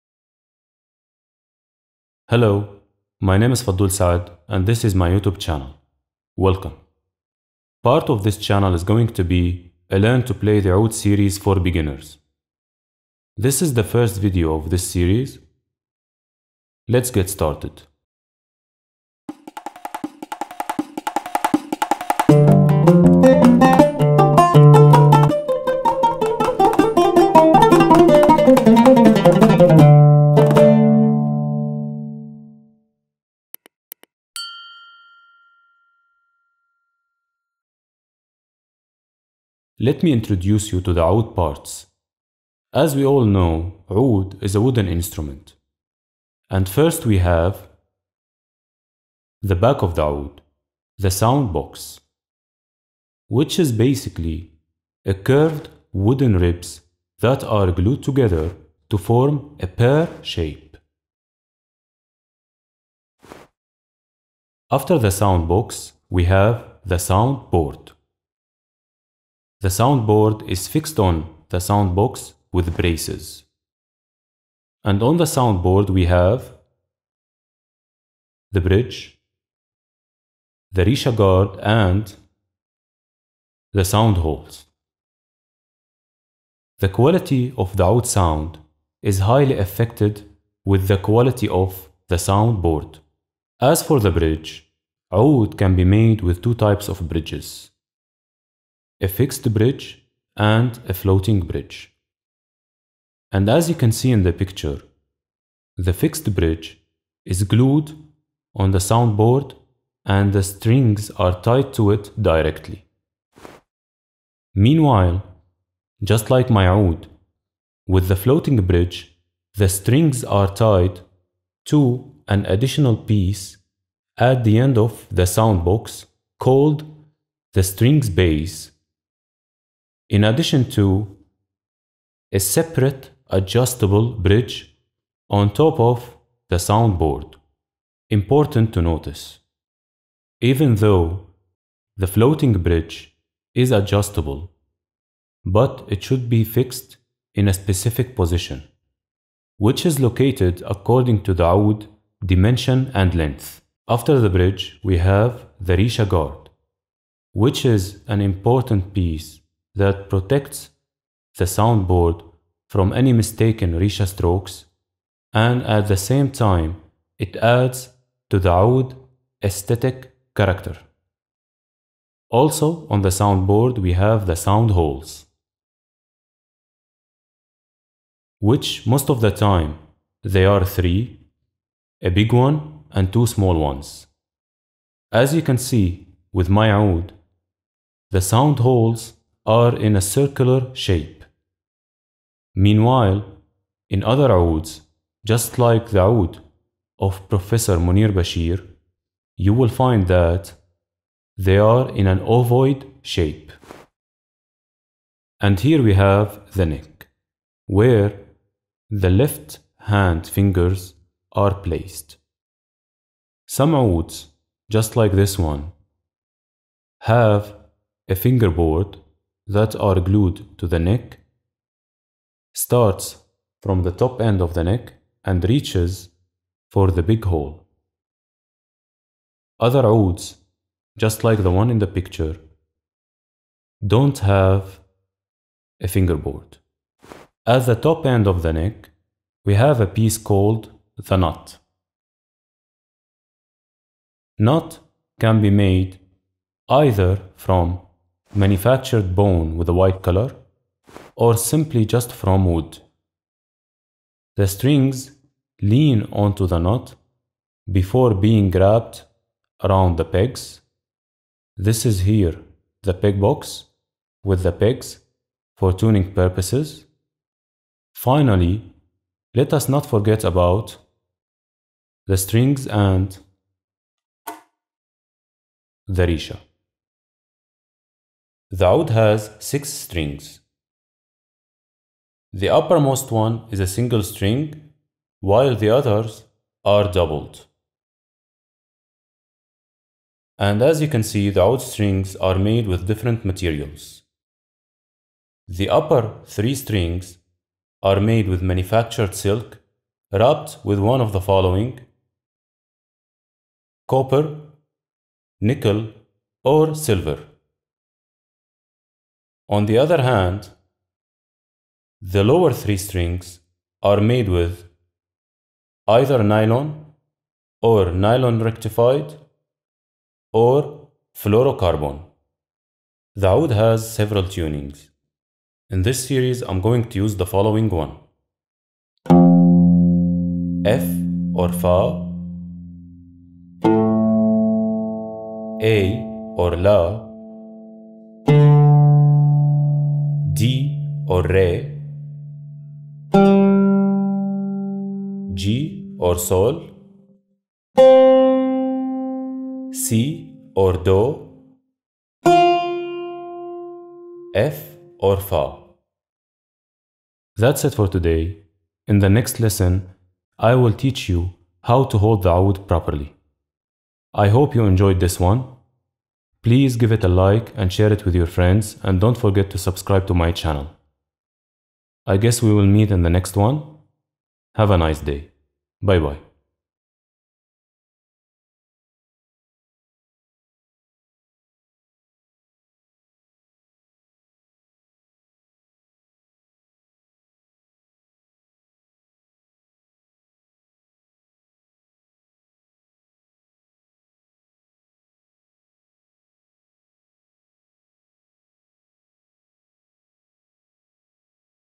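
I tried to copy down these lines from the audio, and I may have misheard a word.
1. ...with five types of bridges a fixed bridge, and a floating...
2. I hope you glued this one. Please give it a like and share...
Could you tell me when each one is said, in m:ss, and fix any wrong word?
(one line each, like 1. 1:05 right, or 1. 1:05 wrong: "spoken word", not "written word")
1. 1:36 wrong: "two", not "five"
2. 6:04 wrong: "enjoyed", not "glued".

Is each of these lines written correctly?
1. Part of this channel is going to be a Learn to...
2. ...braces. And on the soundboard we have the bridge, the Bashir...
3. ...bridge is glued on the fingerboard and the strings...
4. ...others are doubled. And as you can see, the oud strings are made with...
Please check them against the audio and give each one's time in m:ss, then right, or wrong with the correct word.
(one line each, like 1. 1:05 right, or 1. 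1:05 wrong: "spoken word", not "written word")
1. 0:07 right
2. 1:12 wrong: "Risha", not "Bashir"
3. 1:46 wrong: "soundboard", not "fingerboard"
4. 4:45 right.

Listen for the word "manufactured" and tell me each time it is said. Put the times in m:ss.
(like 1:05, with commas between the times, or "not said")
4:08, 4:58.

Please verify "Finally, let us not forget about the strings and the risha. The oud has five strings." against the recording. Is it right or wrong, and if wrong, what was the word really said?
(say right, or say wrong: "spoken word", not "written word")
wrong: "six", not "five".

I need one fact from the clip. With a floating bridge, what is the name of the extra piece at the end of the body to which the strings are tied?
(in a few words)
strings base.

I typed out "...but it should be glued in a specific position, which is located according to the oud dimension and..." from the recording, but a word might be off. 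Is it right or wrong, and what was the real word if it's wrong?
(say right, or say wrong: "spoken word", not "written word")
wrong: "fixed", not "glued".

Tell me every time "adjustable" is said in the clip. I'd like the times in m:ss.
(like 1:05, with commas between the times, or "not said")
2:13, 2:23.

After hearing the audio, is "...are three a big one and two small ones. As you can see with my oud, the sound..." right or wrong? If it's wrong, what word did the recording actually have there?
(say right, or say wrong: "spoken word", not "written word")
right.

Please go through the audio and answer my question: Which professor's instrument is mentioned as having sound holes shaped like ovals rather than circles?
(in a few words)
Munir Bashir.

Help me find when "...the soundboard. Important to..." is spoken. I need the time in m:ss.
2:16.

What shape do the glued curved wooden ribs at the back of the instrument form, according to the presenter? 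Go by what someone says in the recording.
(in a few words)
pear shape.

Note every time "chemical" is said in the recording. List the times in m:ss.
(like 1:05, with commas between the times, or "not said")
not said.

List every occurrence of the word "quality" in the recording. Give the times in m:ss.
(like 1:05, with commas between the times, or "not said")
1:26, 1:30.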